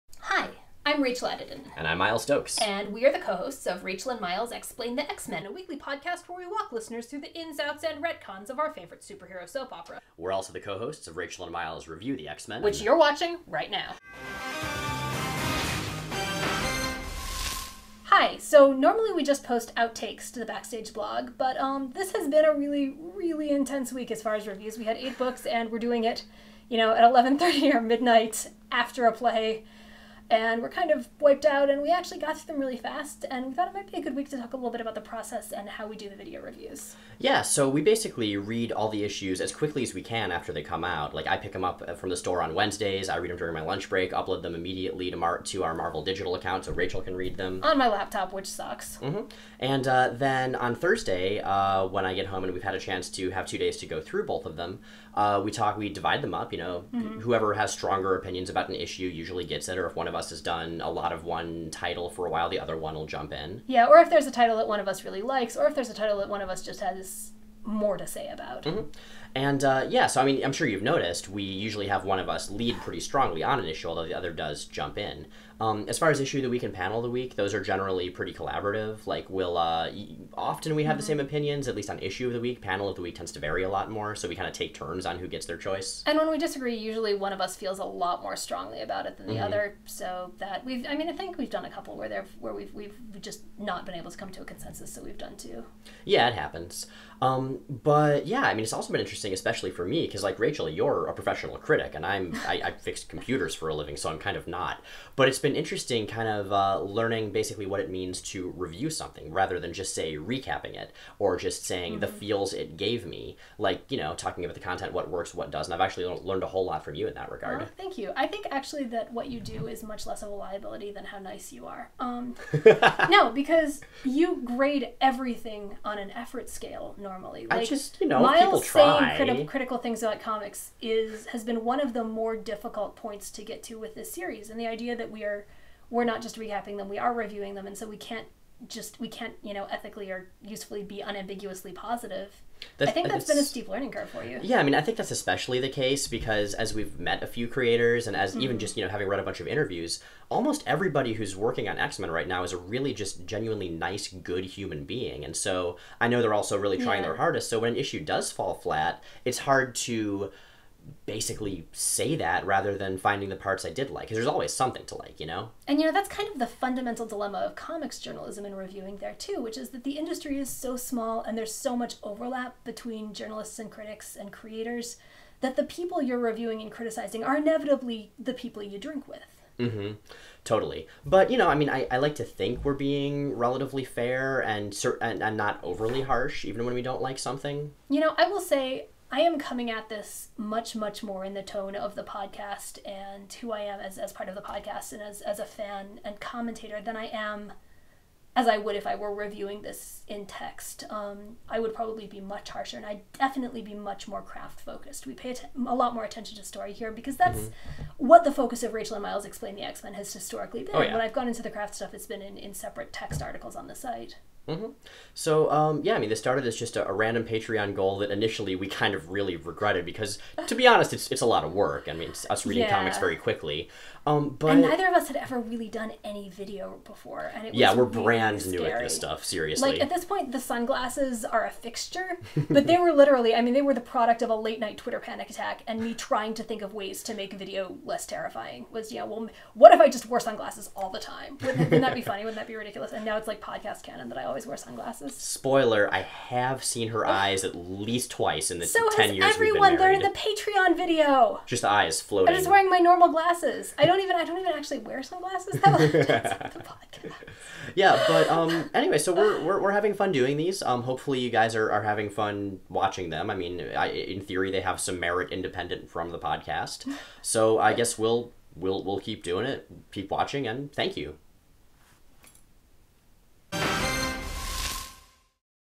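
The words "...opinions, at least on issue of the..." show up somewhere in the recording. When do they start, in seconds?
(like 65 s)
81 s.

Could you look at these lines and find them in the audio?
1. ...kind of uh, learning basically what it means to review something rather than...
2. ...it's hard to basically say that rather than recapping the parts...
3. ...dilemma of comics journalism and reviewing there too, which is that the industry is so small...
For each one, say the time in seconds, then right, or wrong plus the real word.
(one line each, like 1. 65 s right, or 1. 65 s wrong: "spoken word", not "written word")
1. 106 s right
2. 159 s wrong: "finding", not "recapping"
3. 167 s right.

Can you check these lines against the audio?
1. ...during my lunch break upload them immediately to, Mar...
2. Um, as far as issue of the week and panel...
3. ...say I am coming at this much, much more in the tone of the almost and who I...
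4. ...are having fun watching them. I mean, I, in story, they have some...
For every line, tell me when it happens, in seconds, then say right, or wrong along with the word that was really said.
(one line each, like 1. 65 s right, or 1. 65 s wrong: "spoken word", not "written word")
1. 43 s right
2. 75 s right
3. 188 s wrong: "podcast", not "almost"
4. 261 s wrong: "theory", not "story".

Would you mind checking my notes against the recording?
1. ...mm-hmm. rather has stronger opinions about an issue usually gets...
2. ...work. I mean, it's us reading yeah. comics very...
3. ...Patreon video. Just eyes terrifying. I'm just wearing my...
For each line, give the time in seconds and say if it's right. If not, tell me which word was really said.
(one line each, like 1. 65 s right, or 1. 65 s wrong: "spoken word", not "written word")
1. 56 s wrong: "whoever", not "rather"
2. 221 s right
3. 250 s wrong: "floating", not "terrifying".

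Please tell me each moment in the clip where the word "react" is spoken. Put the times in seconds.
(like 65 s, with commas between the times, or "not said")
not said.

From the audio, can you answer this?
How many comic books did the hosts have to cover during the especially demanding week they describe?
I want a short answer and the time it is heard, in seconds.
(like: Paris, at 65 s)
8, at 24 s.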